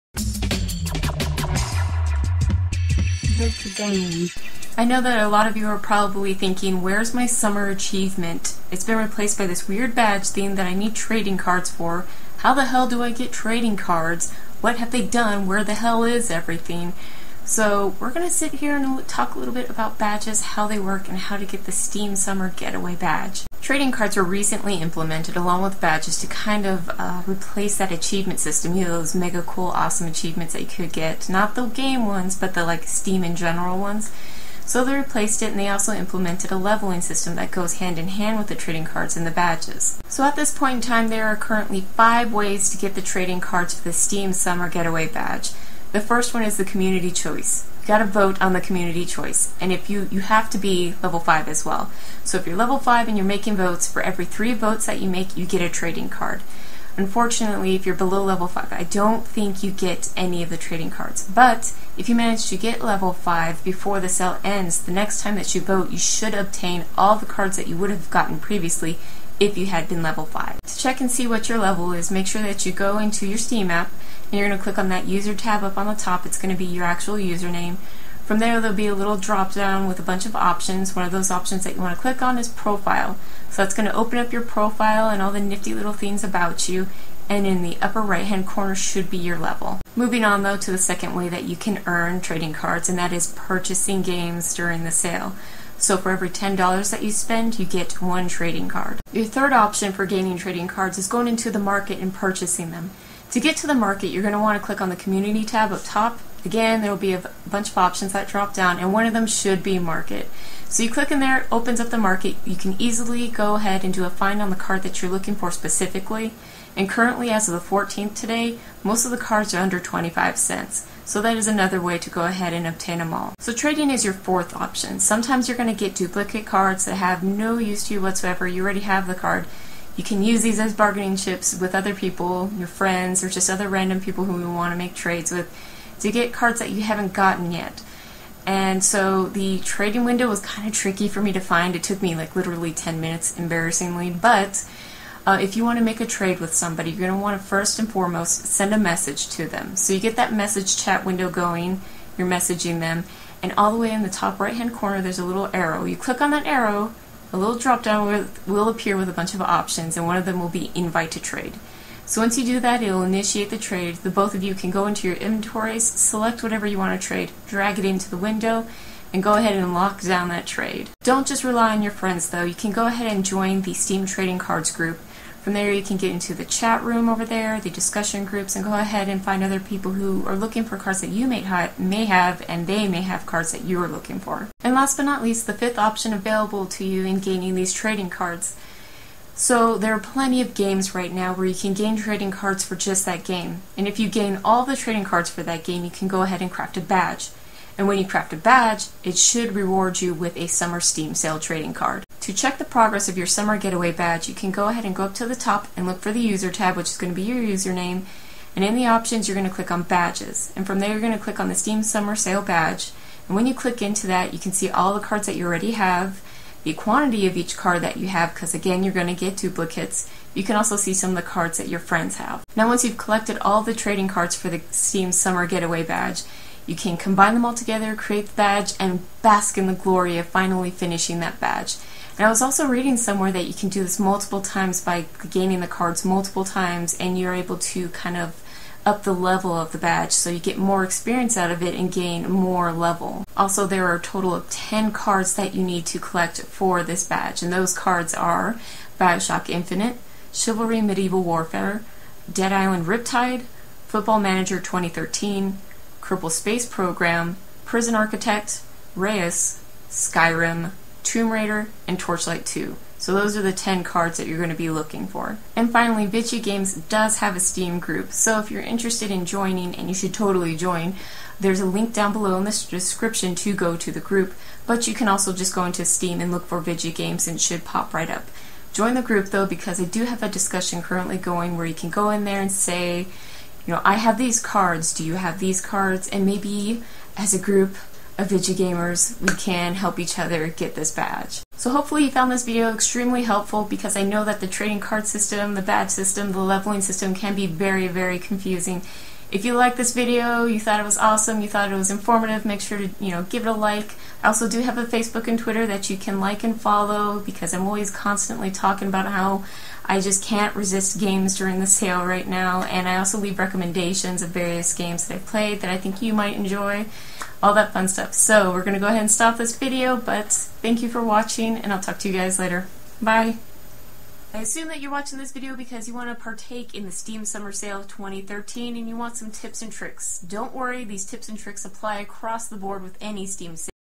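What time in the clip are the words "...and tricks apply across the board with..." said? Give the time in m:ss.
5:31.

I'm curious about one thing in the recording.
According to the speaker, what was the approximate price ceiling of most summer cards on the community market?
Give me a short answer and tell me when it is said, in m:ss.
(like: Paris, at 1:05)
25 cents, at 1:59.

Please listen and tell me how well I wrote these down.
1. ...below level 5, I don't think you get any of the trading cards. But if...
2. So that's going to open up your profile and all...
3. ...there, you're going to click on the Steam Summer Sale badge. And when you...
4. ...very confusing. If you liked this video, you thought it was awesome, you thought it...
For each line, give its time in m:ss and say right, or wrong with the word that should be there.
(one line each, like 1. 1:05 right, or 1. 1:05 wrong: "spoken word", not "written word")
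1. 0:57 right
2. 1:23 right
3. 3:30 right
4. 4:57 right.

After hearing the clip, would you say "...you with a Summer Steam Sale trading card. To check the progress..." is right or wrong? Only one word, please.
right.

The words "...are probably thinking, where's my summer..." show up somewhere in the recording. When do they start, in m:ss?
0:05.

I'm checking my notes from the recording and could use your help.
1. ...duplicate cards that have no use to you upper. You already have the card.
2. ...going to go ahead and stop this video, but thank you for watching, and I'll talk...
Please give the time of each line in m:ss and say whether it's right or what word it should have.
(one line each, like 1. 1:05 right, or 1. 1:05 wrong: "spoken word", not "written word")
1. 2:05 wrong: "whatsoever", not "upper"
2. 5:18 right.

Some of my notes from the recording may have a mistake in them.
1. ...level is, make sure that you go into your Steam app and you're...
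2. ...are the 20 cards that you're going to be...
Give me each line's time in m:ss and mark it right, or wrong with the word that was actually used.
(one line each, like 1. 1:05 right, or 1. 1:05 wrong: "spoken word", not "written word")
1. 1:11 right
2. 4:23 wrong: "10", not "20".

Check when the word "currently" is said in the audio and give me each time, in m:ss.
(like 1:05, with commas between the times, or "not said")
0:41, 1:56, 4:40.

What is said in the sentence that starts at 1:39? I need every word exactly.
Your third option for gaining trading cards is going into the market and purchasing them.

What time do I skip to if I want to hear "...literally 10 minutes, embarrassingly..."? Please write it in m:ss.
2:22.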